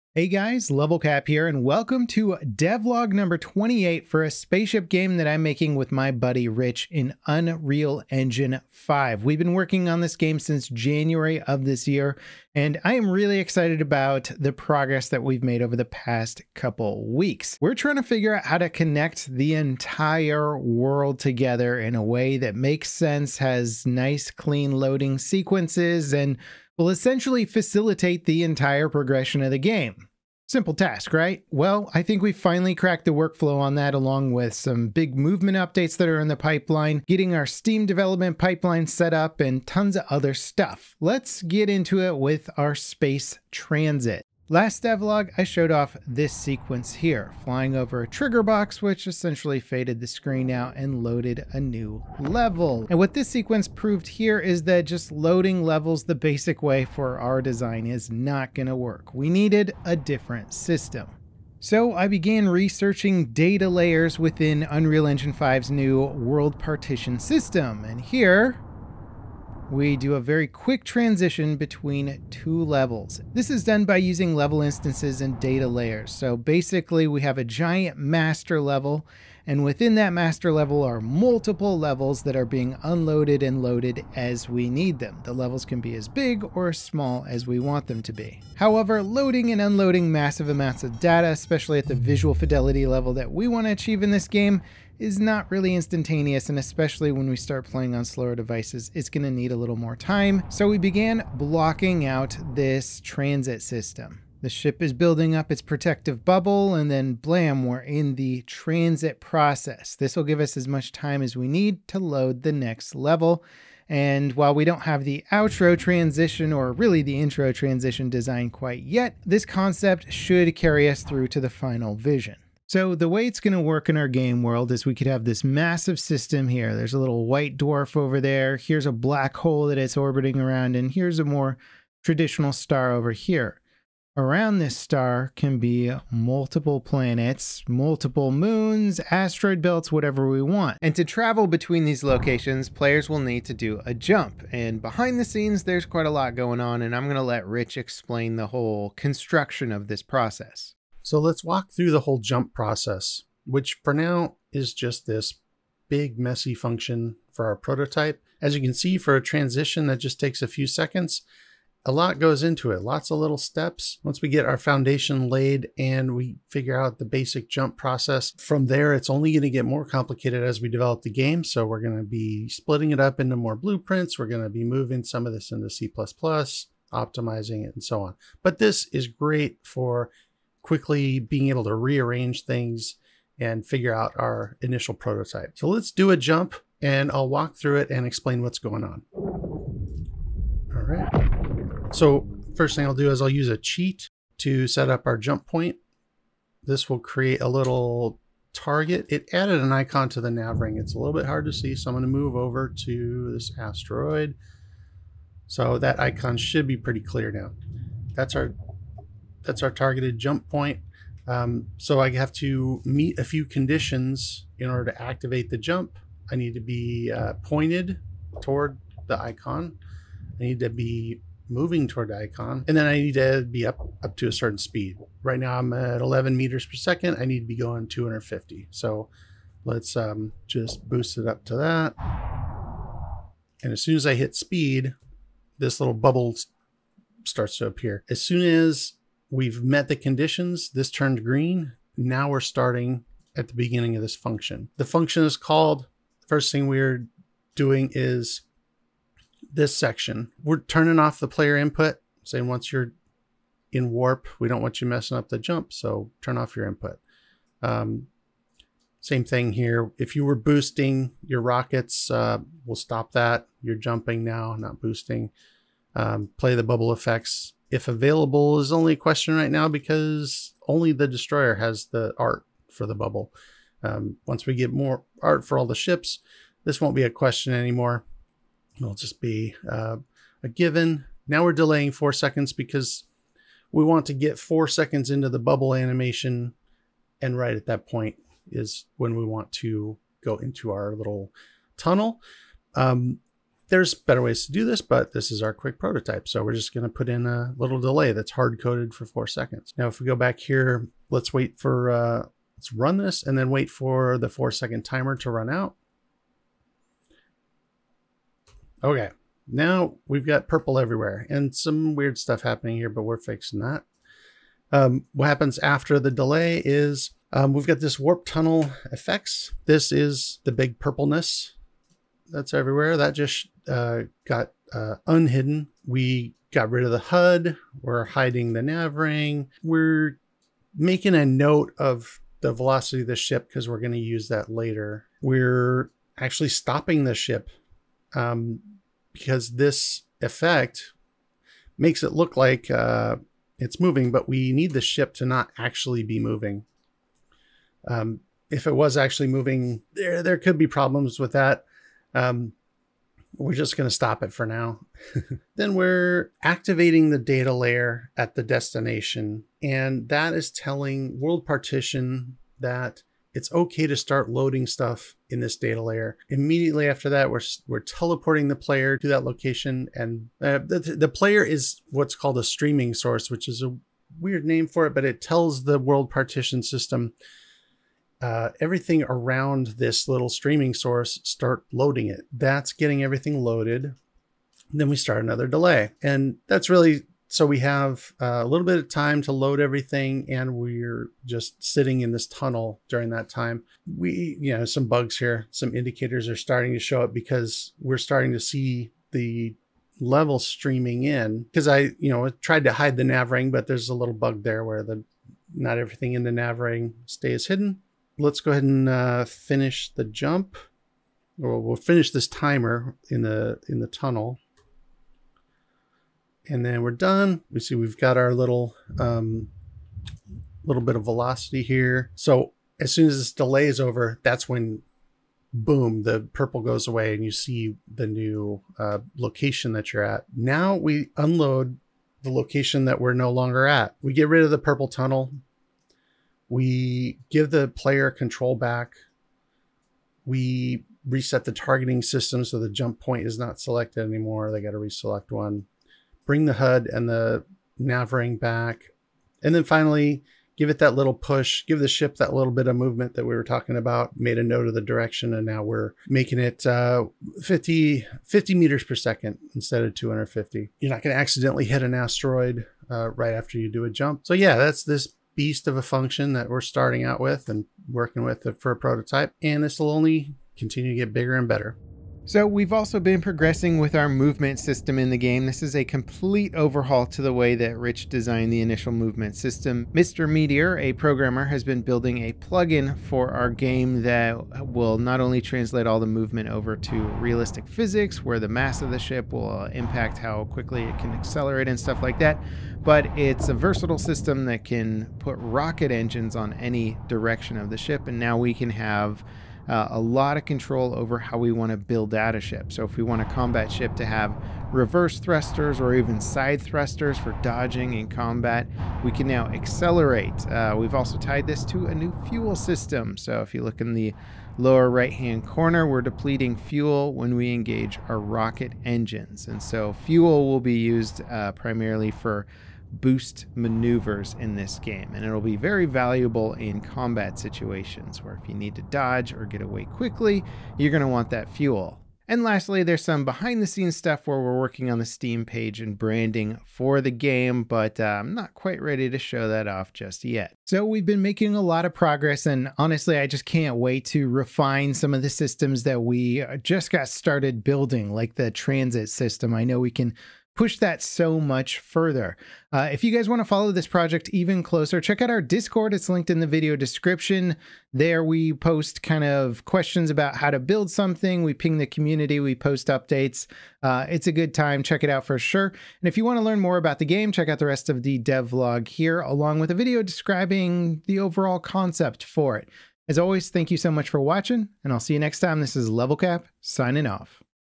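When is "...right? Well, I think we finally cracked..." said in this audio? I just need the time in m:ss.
0:31.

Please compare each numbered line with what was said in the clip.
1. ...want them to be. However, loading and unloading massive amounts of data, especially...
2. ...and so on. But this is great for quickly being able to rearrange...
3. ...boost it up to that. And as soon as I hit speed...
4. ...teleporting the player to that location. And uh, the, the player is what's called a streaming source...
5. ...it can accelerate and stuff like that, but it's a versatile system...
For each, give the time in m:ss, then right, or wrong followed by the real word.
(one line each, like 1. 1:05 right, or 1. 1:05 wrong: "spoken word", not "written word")
1. 1:27 right
2. 2:57 right
3. 3:50 right
4. 6:07 right
5. 8:10 right.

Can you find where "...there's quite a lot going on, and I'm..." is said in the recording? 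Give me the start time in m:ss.
2:25.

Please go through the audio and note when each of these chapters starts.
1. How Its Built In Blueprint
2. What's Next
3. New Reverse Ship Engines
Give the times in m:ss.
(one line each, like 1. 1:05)
1. 2:30
2. 8:51
3. 7:51.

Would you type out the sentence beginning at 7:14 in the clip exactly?
We get rid of the purple tunnel.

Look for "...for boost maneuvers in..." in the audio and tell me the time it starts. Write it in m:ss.
8:42.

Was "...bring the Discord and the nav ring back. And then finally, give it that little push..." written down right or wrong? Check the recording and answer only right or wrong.
wrong.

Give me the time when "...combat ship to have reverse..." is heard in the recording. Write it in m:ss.
8:23.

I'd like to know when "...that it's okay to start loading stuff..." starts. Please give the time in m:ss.
6:02.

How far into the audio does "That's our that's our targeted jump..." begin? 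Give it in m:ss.
3:28.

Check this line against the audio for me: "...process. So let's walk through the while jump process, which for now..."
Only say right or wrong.
wrong.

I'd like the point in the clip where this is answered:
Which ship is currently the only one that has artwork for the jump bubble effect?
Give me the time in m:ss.
4:31.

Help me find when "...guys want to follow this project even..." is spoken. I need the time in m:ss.
9:13.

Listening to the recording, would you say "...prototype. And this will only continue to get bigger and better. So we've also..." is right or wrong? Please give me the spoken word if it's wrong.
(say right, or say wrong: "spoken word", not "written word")
right.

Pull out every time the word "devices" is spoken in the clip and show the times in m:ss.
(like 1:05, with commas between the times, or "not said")
1:38.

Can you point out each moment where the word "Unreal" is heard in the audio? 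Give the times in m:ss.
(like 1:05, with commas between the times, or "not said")
0:07, 1:04.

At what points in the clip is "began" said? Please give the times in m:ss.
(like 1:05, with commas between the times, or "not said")
1:02, 1:40.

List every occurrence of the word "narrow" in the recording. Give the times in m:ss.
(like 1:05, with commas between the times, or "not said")
not said.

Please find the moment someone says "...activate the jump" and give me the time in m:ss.
3:35.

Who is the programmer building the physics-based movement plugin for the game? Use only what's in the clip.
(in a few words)
Mr. Meteor.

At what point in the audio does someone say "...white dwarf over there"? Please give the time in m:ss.
2:07.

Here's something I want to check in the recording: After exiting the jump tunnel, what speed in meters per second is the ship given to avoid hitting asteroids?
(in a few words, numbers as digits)
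50.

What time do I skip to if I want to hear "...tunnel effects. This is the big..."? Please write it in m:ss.
5:18.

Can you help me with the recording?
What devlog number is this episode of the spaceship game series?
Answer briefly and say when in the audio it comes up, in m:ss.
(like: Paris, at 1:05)
28, at 0:03.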